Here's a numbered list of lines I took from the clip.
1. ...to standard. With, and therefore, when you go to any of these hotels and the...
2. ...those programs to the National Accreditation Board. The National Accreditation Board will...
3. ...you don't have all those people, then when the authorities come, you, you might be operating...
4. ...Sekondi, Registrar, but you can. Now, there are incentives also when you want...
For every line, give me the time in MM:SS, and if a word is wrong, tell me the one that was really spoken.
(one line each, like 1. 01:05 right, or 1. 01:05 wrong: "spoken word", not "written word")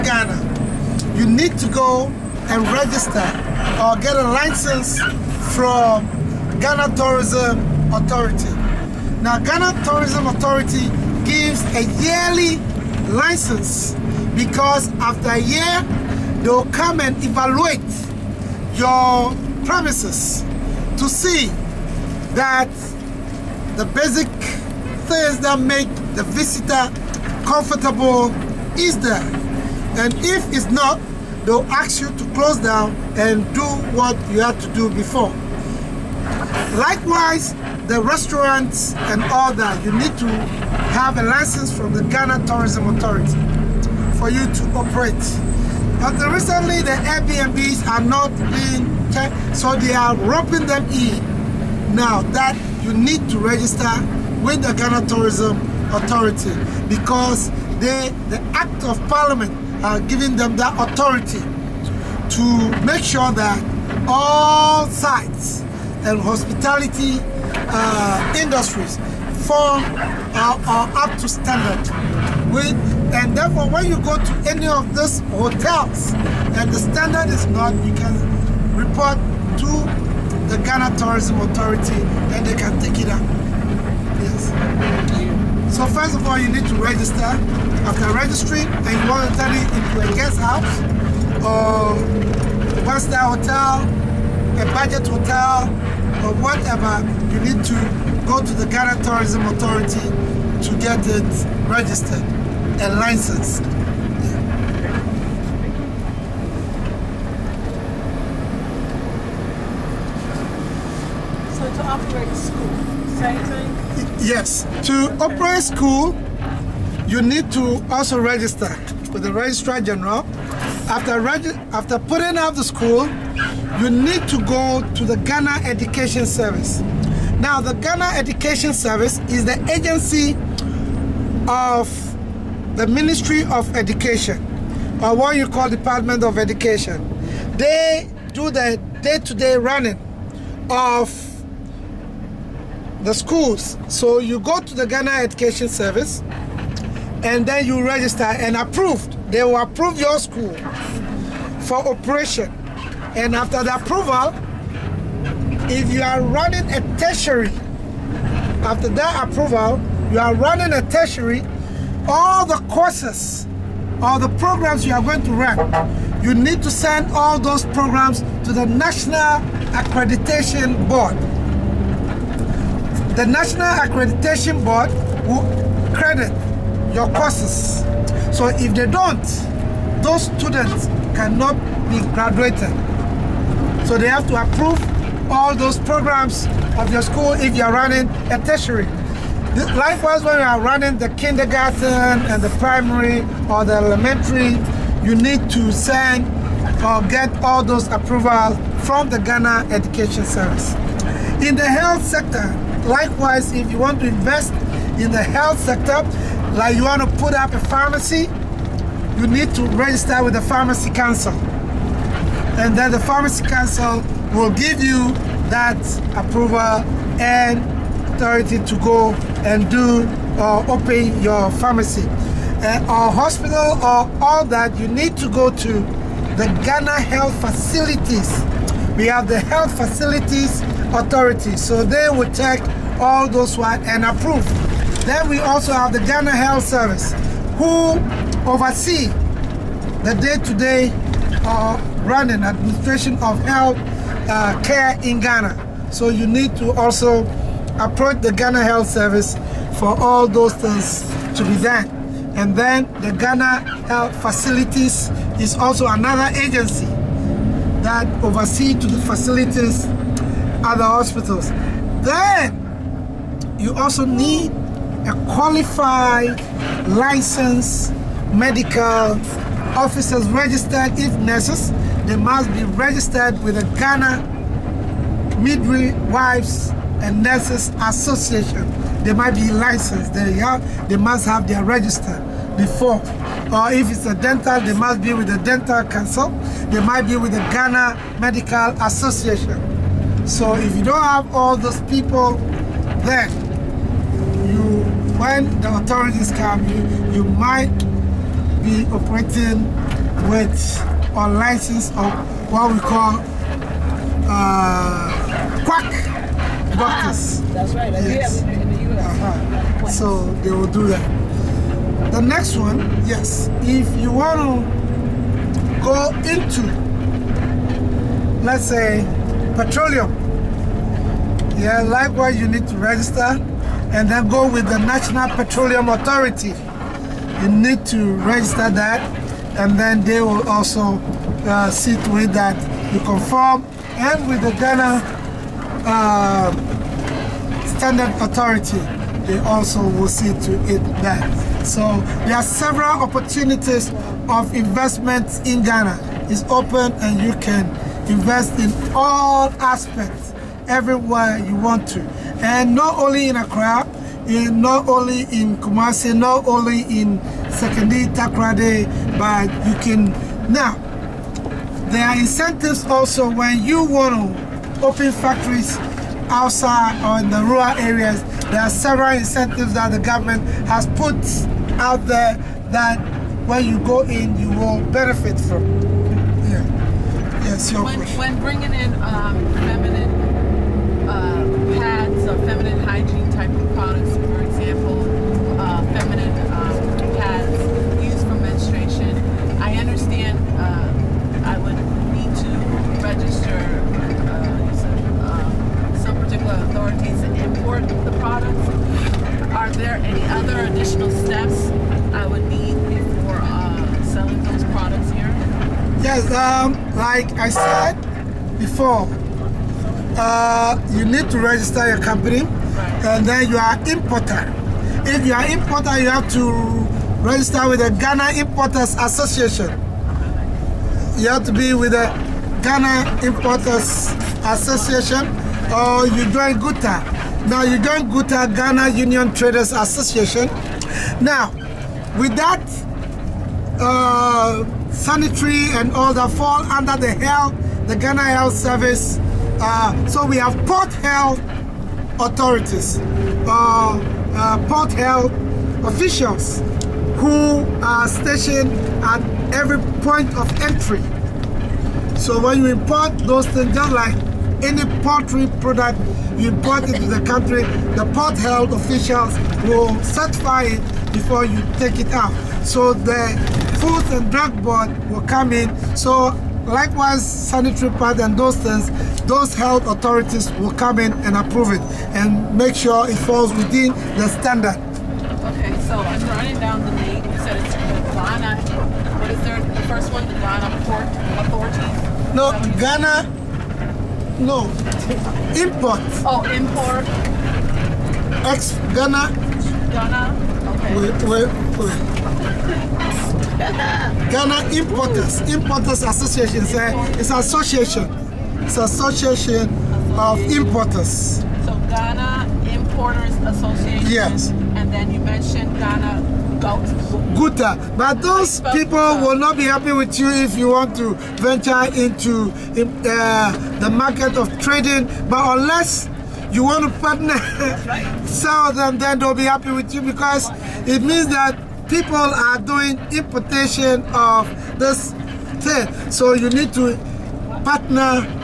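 1. 01:11 right
2. 02:47 right
3. 04:50 right
4. 05:57 wrong: "Takoradi", not "Registrar".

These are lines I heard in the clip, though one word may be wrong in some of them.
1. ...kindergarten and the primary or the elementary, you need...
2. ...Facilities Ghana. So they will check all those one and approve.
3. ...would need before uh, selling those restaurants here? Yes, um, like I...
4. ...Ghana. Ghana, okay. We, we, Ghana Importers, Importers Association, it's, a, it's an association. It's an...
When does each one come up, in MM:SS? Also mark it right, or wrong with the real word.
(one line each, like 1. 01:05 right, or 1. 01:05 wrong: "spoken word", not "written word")
1. 03:11 right
2. 03:49 wrong: "Authority", not "Ghana"
3. 06:42 wrong: "products", not "restaurants"
4. 08:08 right.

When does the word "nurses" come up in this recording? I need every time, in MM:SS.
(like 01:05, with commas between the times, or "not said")
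04:31, 04:37.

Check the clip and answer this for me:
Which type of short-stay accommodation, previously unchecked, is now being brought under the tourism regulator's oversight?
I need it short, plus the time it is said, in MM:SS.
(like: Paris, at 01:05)
Airbnbs, at 00:47.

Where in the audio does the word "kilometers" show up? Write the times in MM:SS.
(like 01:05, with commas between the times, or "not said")
not said.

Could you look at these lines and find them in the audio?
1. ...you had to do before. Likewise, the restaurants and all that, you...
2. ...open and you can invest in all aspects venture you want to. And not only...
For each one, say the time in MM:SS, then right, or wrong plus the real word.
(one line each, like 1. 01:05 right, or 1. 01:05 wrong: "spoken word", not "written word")
1. 00:34 right
2. 05:46 wrong: "everywhere", not "venture".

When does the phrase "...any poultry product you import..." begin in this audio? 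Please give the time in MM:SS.
07:34.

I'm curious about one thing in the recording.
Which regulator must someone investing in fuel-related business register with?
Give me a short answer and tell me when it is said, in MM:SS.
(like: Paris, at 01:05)
National Petroleum Authority, at 05:24.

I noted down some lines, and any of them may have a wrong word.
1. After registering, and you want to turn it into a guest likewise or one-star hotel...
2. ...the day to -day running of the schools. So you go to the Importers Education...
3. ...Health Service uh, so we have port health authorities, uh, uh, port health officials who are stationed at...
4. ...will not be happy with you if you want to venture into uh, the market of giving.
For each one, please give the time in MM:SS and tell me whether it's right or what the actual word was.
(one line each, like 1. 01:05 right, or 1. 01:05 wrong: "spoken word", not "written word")
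1. 01:27 wrong: "house", not "likewise"
2. 02:18 wrong: "Ghana", not "Importers"
3. 07:18 right
4. 08:29 wrong: "trading", not "giving".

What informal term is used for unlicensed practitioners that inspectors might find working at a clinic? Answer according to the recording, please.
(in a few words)
Quack doctors.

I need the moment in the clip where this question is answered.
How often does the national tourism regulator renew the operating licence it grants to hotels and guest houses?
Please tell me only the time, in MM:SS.
00:12.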